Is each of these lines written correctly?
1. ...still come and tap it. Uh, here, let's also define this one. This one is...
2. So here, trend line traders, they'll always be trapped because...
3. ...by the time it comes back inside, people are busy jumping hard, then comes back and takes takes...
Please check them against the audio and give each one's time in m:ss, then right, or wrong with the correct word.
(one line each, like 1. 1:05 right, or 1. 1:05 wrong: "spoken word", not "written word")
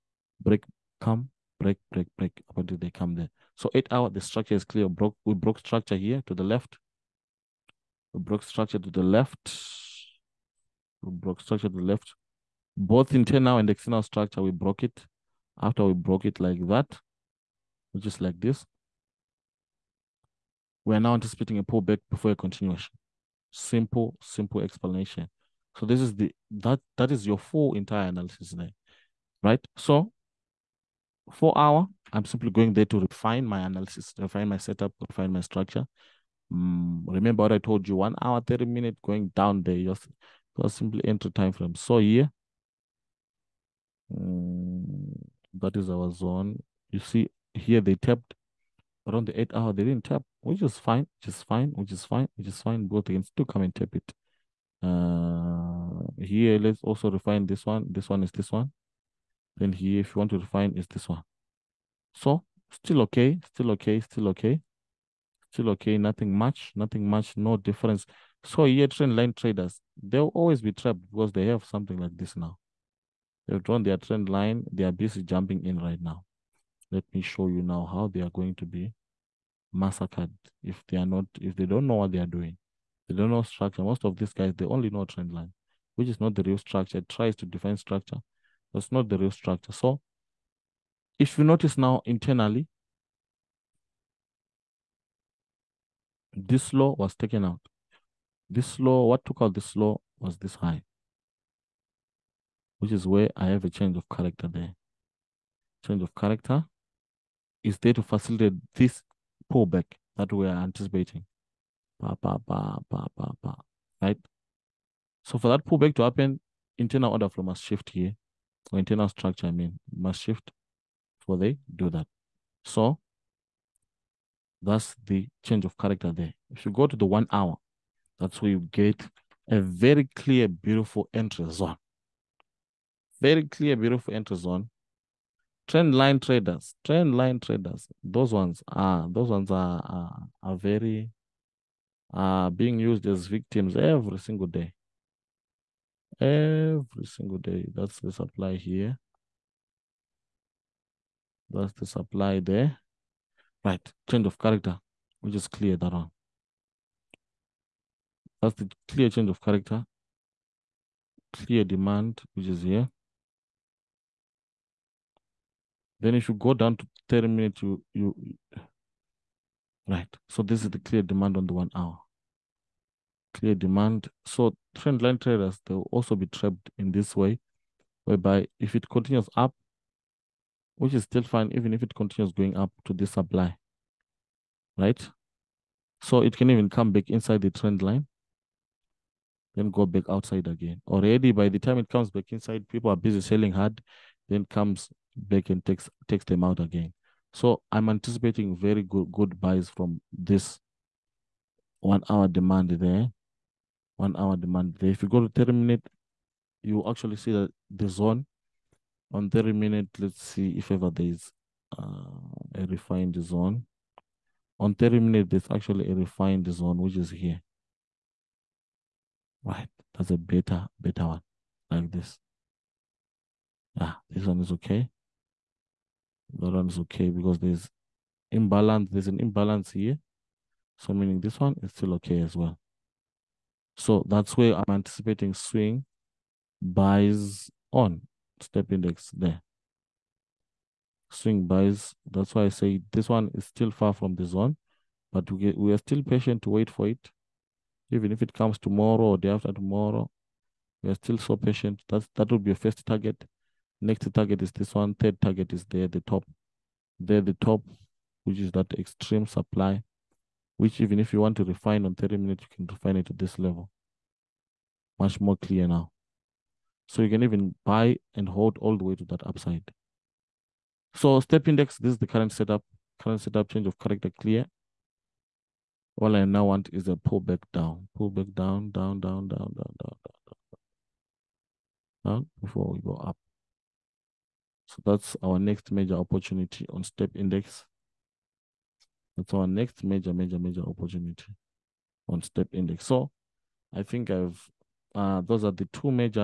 1. 0:53 wrong: "refine", not "define"
2. 1:08 right
3. 3:11 wrong: "selling", not "jumping".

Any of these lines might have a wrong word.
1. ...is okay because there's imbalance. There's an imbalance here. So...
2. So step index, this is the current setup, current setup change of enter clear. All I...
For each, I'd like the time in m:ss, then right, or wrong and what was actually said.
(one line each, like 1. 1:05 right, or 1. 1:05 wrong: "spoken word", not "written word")
1. 3:46 right
2. 4:30 wrong: "character", not "enter".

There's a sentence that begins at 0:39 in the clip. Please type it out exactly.
Just just simply enter time frame.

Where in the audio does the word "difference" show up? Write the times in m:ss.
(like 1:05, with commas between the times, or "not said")
1:07.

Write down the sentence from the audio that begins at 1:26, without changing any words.
It tries to define structure, but not the real structure.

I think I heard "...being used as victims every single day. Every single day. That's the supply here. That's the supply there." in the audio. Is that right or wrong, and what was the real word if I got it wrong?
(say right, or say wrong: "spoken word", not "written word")
right.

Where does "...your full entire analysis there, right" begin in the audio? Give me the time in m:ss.
0:27.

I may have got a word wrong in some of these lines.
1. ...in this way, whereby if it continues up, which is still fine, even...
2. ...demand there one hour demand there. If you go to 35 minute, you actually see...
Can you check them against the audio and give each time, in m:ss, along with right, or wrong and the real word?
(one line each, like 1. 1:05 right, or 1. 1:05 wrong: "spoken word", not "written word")
1. 2:56 right
2. 3:22 wrong: "30", not "35".